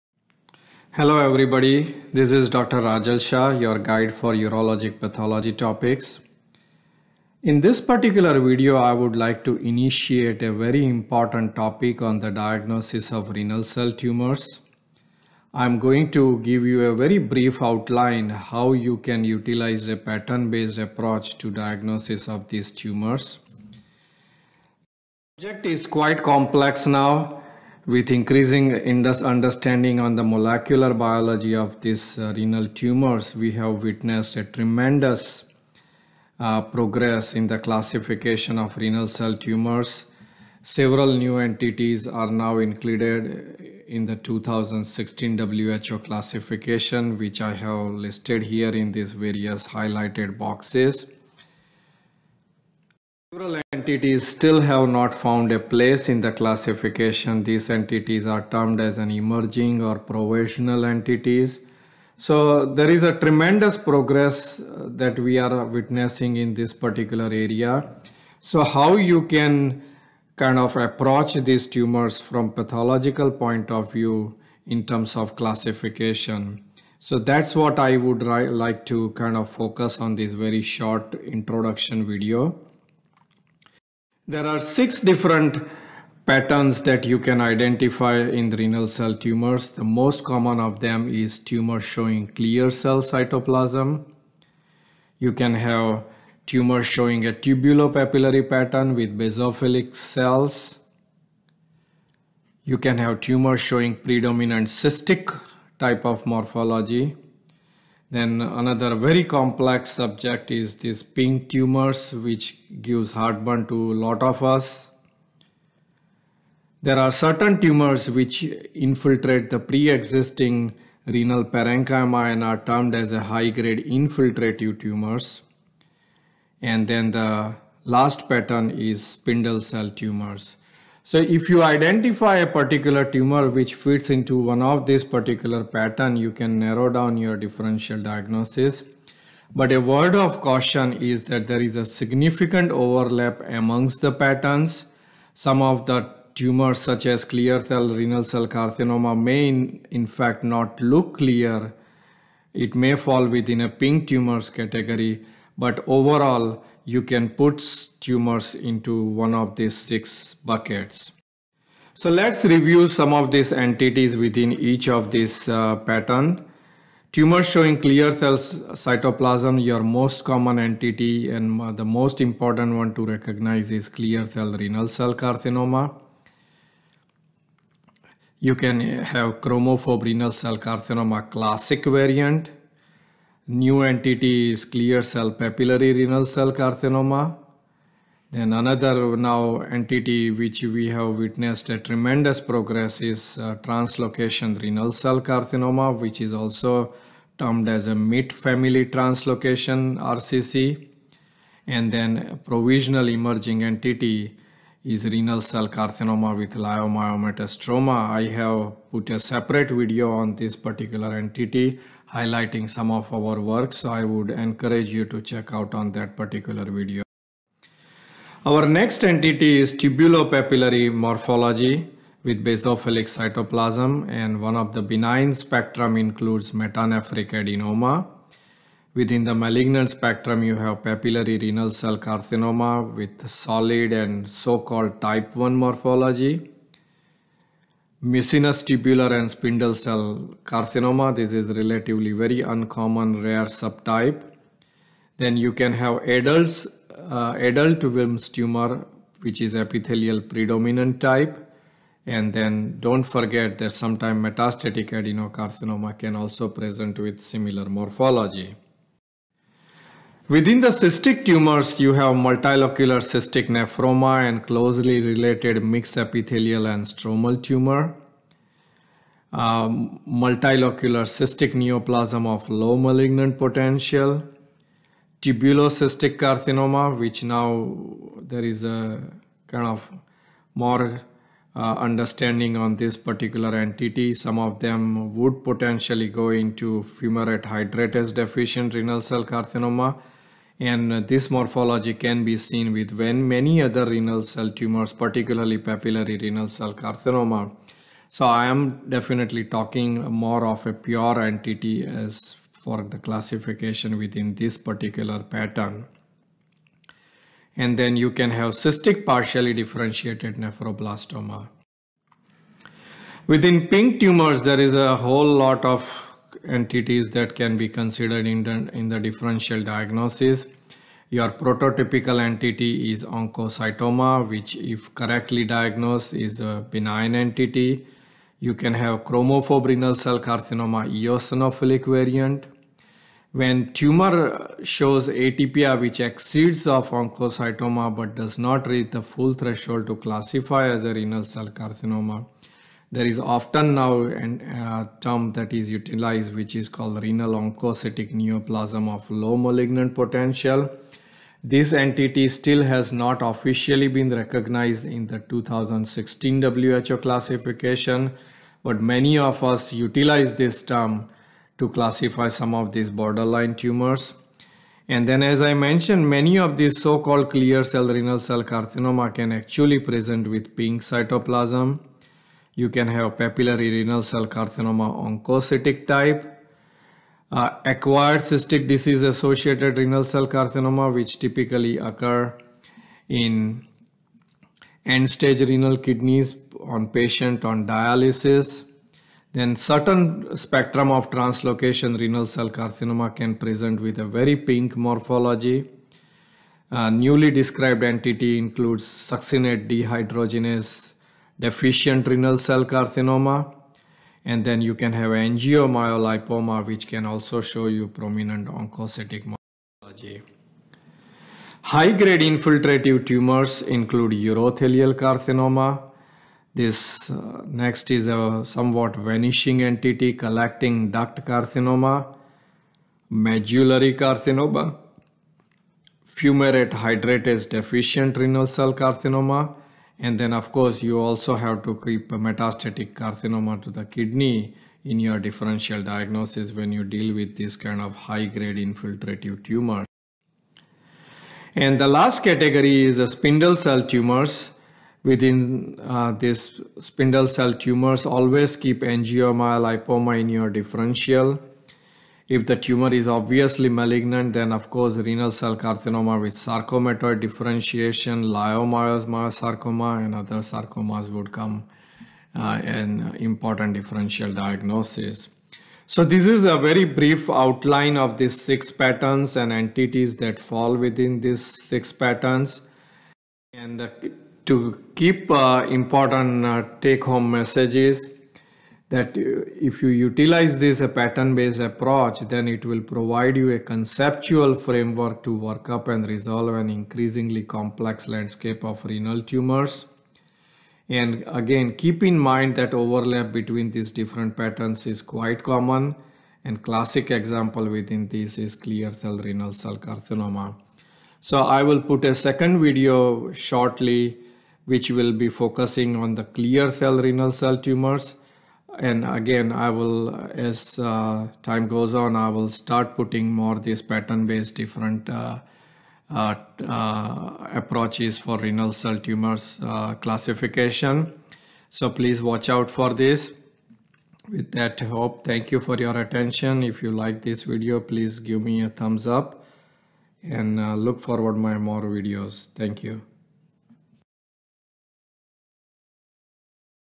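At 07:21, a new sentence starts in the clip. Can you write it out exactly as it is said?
And the last category is the spindle cell tumors.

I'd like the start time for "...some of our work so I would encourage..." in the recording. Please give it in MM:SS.
03:32.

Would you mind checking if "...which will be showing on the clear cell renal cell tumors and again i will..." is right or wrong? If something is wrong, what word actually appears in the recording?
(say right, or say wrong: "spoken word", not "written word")
wrong: "focusing", not "showing".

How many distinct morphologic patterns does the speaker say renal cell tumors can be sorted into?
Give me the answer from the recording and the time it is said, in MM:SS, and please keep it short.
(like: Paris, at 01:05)
6, at 01:24.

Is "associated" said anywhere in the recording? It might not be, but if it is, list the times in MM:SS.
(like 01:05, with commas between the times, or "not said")
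06:19.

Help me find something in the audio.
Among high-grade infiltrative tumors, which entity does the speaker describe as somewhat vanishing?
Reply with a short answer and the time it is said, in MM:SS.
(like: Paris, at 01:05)
Collecting duct carcinoma, at 07:00.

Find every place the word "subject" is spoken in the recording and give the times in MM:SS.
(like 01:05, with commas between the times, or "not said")
00:25, 01:49.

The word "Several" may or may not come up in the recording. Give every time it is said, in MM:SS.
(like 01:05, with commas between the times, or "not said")
00:40, 00:53.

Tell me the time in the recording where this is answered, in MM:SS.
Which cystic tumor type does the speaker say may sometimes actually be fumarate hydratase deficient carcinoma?
04:35.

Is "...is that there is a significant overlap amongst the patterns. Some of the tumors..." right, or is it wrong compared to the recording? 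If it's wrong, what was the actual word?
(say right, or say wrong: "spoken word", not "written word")
right.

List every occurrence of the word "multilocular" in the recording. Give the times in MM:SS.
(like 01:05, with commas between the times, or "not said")
04:22, 04:30.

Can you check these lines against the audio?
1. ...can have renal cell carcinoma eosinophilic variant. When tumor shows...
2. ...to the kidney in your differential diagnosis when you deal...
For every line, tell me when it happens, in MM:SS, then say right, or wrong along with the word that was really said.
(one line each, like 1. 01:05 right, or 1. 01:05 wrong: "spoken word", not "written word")
1. 05:28 right
2. 07:13 right.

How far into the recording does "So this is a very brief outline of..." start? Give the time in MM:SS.
07:45.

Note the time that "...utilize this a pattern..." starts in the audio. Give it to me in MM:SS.
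08:00.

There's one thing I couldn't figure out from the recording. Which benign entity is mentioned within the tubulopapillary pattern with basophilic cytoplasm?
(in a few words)
Metanephric adenoma.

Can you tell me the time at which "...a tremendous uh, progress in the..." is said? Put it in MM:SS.
00:34.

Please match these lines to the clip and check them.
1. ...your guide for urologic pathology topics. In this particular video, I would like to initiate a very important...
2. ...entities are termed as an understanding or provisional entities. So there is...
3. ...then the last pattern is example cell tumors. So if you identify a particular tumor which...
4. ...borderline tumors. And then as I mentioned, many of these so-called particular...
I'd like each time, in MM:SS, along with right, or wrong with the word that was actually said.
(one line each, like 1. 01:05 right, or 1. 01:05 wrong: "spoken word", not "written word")
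1. 00:03 right
2. 00:57 wrong: "emerging", not "understanding"
3. 02:06 wrong: "spindle", not "example"
4. 06:02 wrong: "clear", not "particular".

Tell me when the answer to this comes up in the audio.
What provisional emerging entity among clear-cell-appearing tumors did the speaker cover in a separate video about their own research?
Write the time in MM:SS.
03:25.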